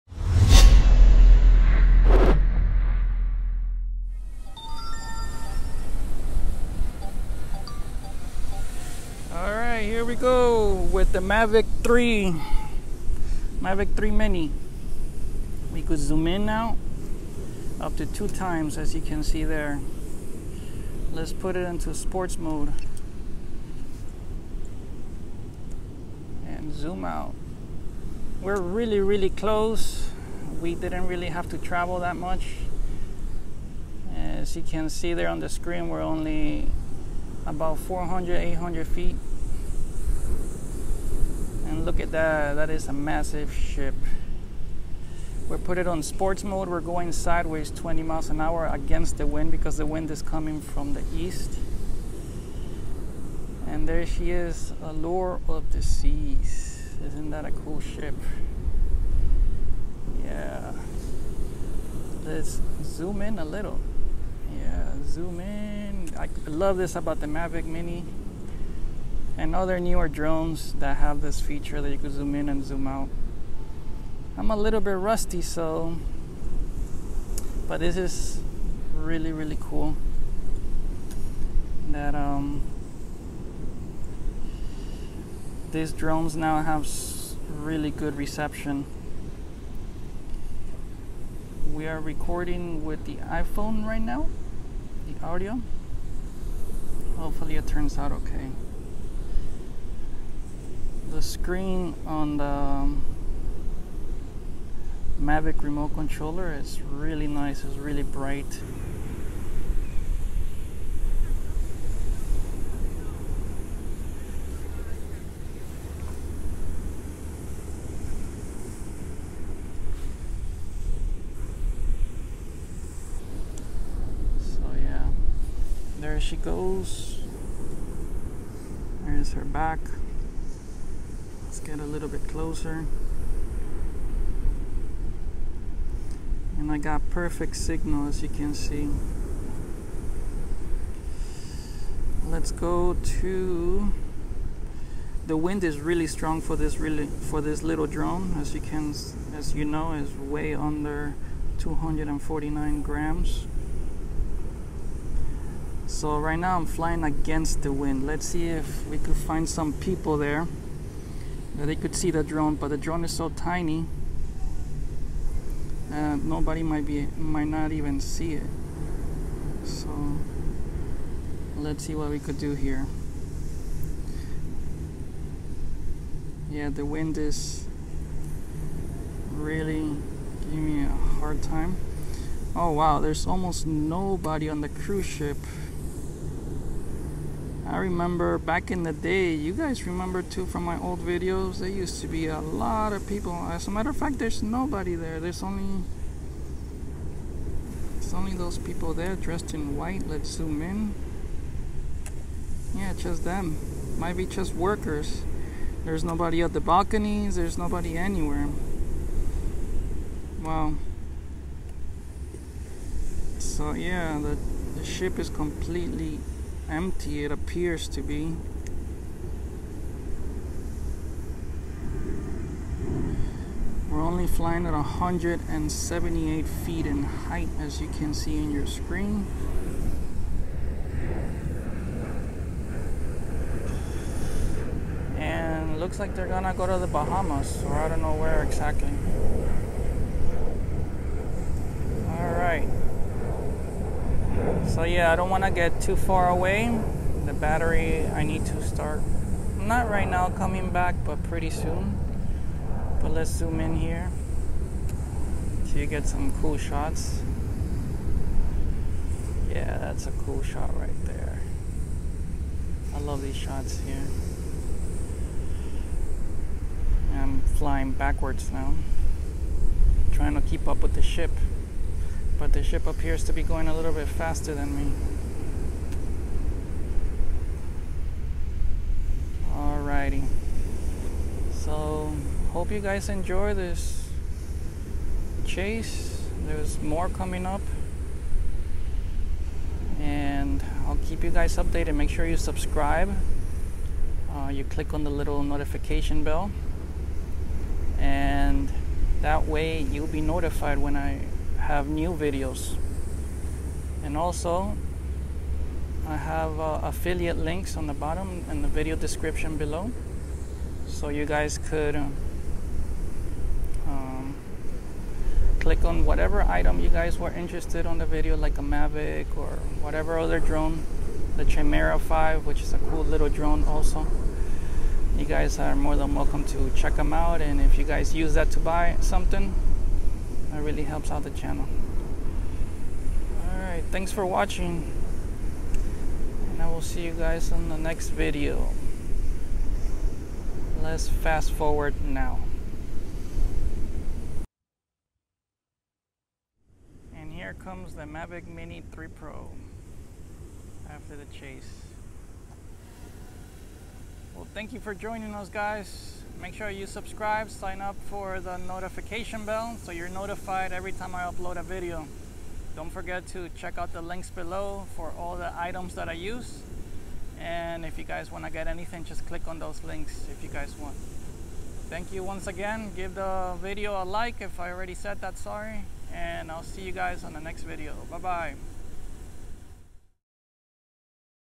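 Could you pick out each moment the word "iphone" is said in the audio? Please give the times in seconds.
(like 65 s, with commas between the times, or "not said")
93 s.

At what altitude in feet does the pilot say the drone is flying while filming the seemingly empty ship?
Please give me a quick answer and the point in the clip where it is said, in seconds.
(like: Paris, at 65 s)
178 feet, at 224 s.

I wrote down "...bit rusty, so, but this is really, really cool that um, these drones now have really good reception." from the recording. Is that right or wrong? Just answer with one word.
right.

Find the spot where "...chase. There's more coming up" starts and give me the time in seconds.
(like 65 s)
285 s.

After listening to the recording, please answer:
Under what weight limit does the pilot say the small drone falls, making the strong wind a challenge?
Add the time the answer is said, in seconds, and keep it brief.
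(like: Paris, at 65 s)
249 grams, at 151 s.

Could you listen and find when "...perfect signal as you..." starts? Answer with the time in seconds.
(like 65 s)
137 s.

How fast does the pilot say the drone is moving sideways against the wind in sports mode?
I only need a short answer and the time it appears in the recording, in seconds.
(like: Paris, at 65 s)
20 miles an hour, at 47 s.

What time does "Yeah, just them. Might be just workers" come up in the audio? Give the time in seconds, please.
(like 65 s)
202 s.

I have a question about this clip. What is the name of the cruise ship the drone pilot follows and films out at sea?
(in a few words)
Allure of the Seas.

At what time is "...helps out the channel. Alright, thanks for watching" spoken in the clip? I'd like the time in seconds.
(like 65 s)
330 s.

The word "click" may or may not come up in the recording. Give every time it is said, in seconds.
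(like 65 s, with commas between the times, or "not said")
294 s, 315 s, 369 s.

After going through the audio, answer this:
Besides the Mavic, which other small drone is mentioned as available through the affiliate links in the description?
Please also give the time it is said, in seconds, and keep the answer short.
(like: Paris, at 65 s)
Chimera 5, at 321 s.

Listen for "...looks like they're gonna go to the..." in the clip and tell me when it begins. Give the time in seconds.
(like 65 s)
235 s.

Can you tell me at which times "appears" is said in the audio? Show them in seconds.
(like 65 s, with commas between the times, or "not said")
217 s, 272 s.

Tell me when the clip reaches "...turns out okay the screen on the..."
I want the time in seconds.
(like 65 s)
97 s.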